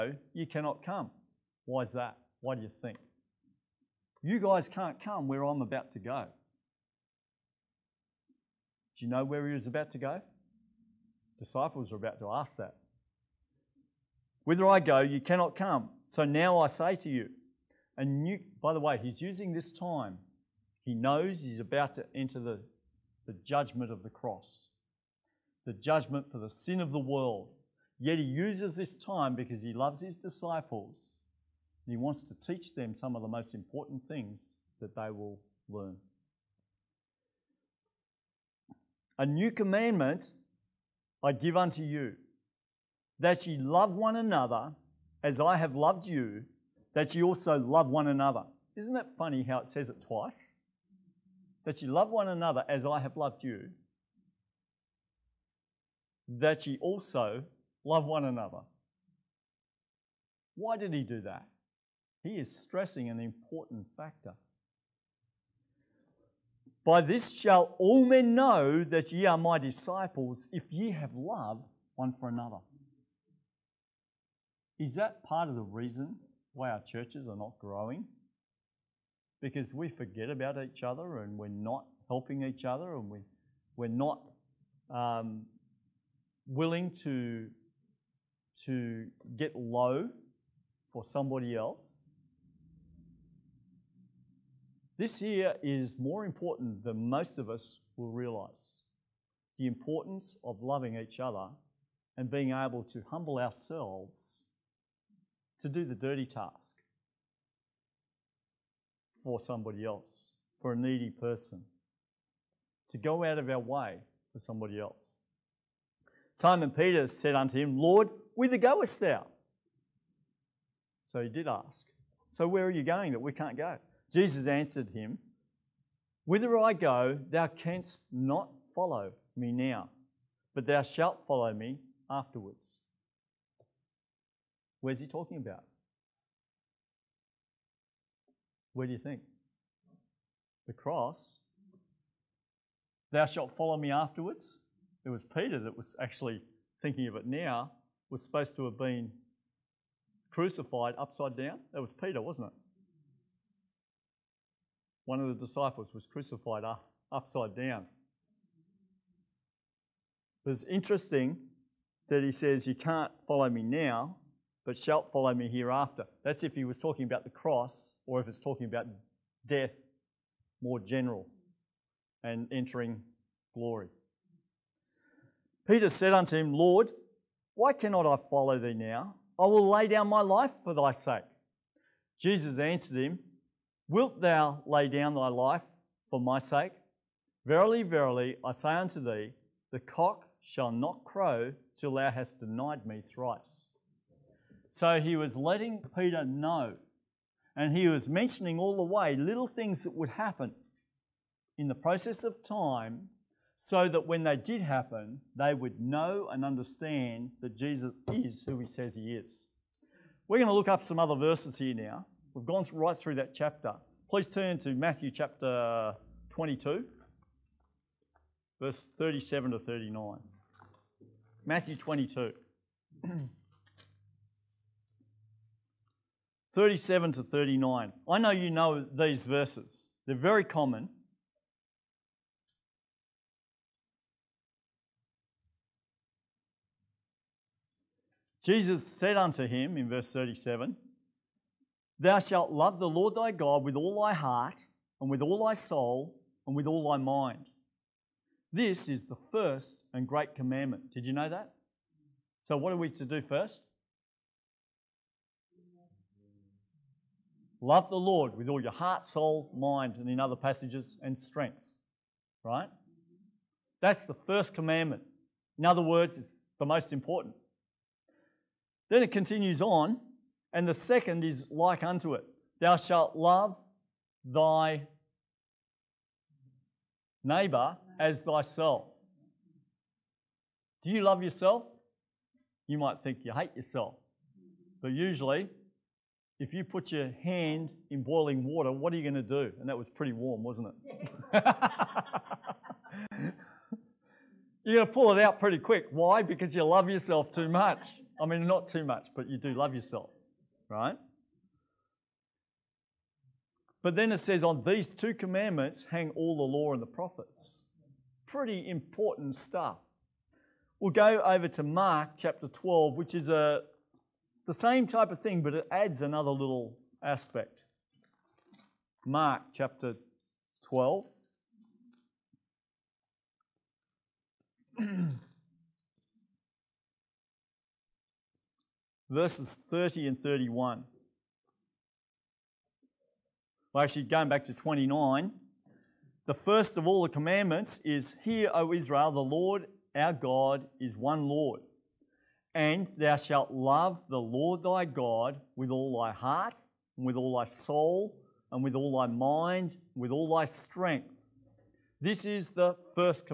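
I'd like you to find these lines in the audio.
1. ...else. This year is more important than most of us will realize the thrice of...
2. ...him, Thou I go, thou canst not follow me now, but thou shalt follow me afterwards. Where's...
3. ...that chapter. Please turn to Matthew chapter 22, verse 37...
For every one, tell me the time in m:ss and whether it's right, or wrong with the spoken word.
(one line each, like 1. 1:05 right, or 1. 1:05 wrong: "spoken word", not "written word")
1. 1:31 wrong: "importance", not "thrice"
2. 2:04 wrong: "Whither", not "Thou"
3. 3:33 right.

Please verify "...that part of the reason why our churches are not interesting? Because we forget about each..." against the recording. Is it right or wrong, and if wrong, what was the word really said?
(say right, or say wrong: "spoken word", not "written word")
wrong: "growing", not "interesting".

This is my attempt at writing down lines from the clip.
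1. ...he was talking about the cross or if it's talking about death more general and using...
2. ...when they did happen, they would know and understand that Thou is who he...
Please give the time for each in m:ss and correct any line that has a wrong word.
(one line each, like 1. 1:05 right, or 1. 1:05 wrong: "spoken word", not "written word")
1. 2:46 wrong: "entering", not "using"
2. 3:24 wrong: "Jesus", not "Thou".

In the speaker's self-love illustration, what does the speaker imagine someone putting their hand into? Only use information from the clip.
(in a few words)
Boiling water.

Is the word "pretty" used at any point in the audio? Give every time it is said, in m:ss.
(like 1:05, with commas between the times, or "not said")
4:49, 4:55, 5:08.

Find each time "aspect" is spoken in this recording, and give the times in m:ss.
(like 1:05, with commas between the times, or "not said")
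5:17.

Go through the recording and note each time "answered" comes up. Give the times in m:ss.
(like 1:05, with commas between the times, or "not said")
2:04, 3:02.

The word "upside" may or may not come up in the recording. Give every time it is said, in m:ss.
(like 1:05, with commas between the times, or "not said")
2:30, 2:37.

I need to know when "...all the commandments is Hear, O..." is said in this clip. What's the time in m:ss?
5:36.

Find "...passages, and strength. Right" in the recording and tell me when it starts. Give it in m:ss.
4:20.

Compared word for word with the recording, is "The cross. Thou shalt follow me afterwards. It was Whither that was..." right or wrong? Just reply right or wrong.
wrong.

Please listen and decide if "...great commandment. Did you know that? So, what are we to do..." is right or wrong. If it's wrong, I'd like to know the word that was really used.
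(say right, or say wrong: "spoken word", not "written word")
right.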